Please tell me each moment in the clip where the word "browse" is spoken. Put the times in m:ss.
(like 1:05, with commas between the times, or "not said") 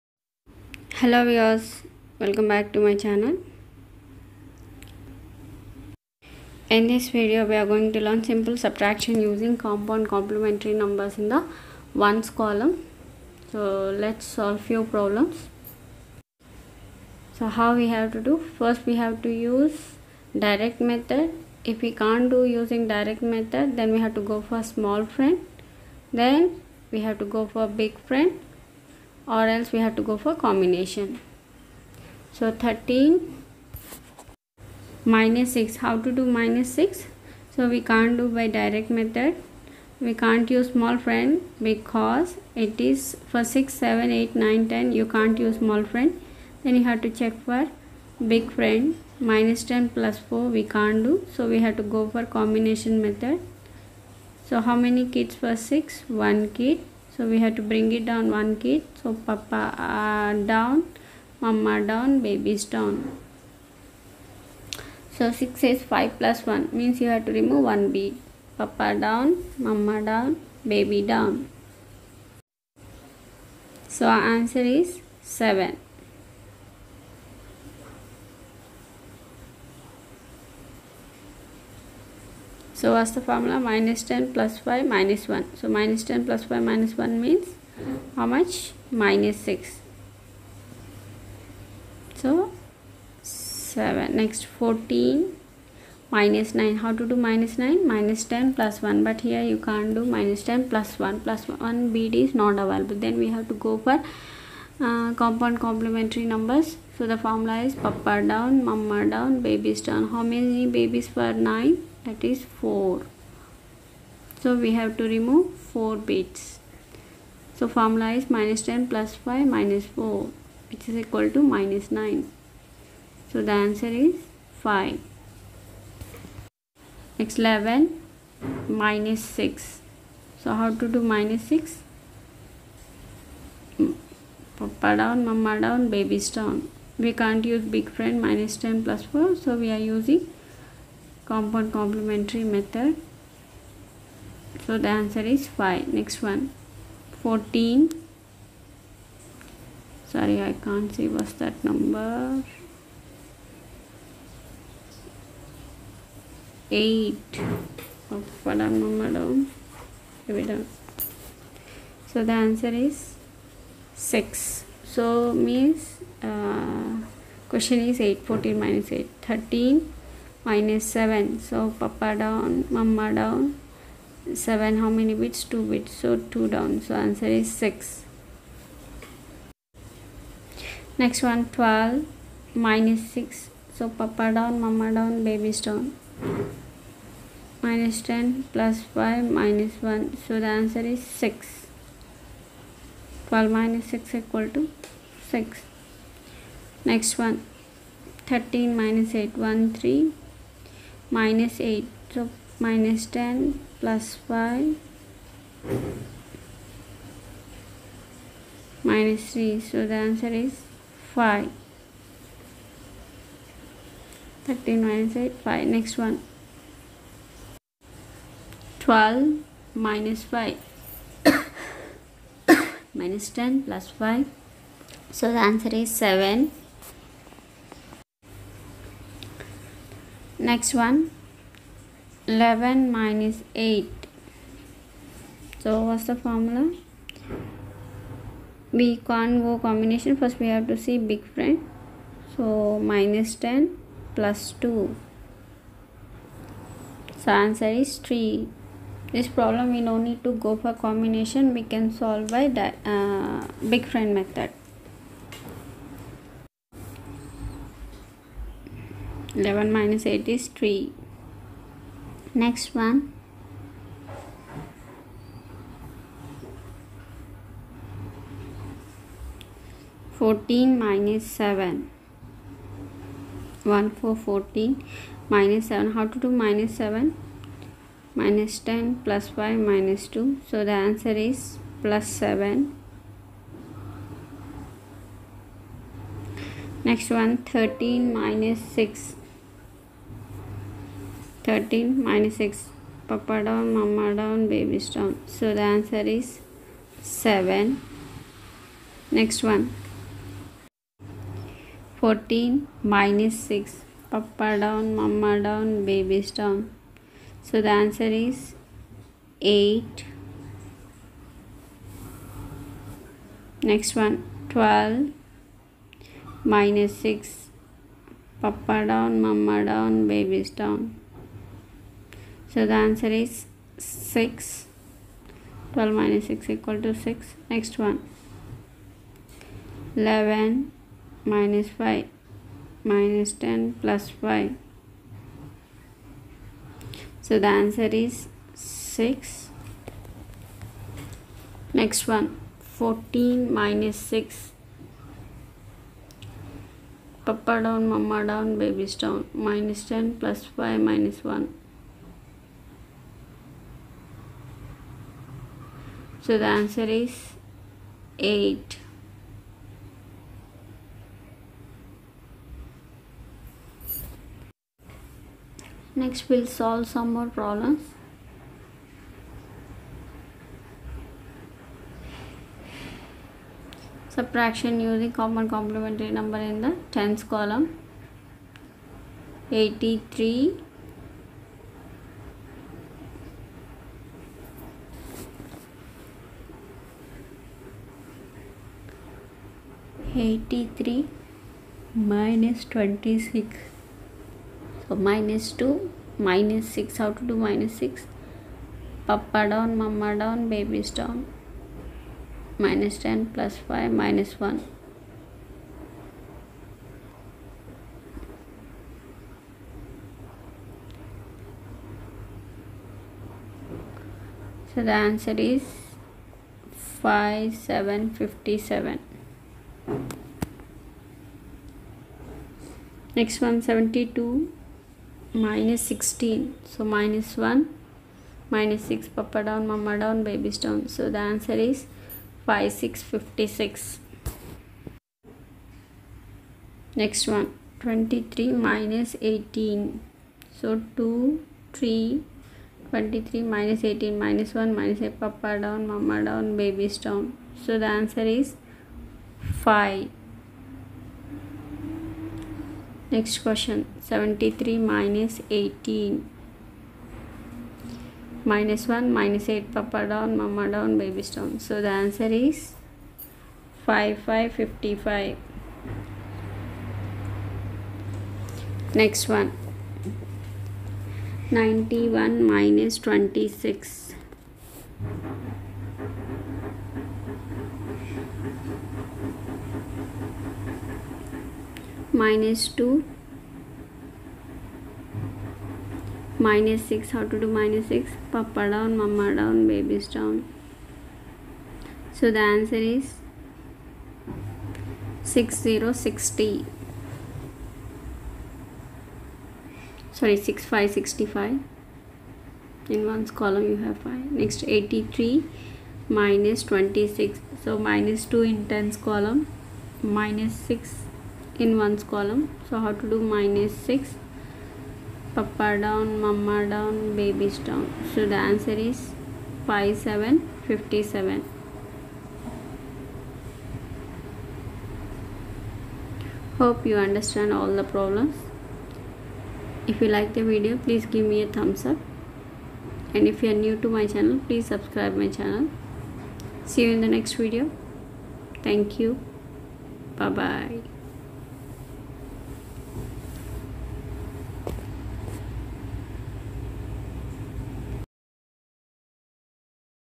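not said.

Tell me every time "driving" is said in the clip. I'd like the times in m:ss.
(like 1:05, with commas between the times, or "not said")
not said.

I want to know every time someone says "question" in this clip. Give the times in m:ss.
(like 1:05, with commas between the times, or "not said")
2:47, 7:33.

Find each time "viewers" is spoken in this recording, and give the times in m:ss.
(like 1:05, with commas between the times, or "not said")
0:01.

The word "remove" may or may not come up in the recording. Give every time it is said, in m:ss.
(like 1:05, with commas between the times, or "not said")
1:07, 1:55.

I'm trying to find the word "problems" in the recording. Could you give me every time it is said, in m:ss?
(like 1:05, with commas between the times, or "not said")
0:14, 4:09, 6:07, 8:47.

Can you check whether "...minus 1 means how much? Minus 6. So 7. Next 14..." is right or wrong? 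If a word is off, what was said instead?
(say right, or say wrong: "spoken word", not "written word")
right.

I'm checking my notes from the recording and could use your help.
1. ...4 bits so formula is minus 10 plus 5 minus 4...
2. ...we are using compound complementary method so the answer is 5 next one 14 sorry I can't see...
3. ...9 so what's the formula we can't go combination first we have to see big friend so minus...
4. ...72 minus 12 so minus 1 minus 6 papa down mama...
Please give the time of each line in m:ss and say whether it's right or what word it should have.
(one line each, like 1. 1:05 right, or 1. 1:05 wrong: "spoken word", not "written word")
1. 1:55 right
2. 2:19 right
3. 3:53 wrong: "8", not "9"
4. 7:03 wrong: "16", not "12".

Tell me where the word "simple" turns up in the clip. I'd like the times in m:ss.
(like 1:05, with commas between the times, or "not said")
0:08.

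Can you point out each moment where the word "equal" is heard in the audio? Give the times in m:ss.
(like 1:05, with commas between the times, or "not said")
2:01, 3:14, 5:26.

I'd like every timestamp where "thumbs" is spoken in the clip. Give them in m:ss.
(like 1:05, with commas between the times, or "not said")
8:51.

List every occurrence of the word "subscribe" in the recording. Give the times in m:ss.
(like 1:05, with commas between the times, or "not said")
8:54.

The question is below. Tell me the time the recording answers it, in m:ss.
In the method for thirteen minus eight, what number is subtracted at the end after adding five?
3:22.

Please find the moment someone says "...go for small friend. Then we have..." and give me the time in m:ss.
0:24.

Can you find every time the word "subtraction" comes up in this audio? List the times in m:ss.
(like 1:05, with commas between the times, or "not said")
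0:08, 6:14.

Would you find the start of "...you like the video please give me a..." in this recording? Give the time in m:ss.
8:50.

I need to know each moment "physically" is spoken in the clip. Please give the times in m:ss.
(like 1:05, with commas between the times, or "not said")
not said.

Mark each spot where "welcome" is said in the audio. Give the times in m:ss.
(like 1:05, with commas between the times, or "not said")
0:02.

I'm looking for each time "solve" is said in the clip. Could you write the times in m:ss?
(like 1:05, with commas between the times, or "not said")
0:14, 4:11, 6:06.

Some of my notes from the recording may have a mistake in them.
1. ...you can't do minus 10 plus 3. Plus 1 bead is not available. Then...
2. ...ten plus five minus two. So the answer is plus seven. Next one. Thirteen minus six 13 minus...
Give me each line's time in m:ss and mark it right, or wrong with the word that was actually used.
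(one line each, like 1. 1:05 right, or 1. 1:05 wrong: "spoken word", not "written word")
1. 1:39 wrong: "1", not "3"
2. 4:38 right.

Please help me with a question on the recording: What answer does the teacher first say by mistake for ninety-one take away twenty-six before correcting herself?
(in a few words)
6060.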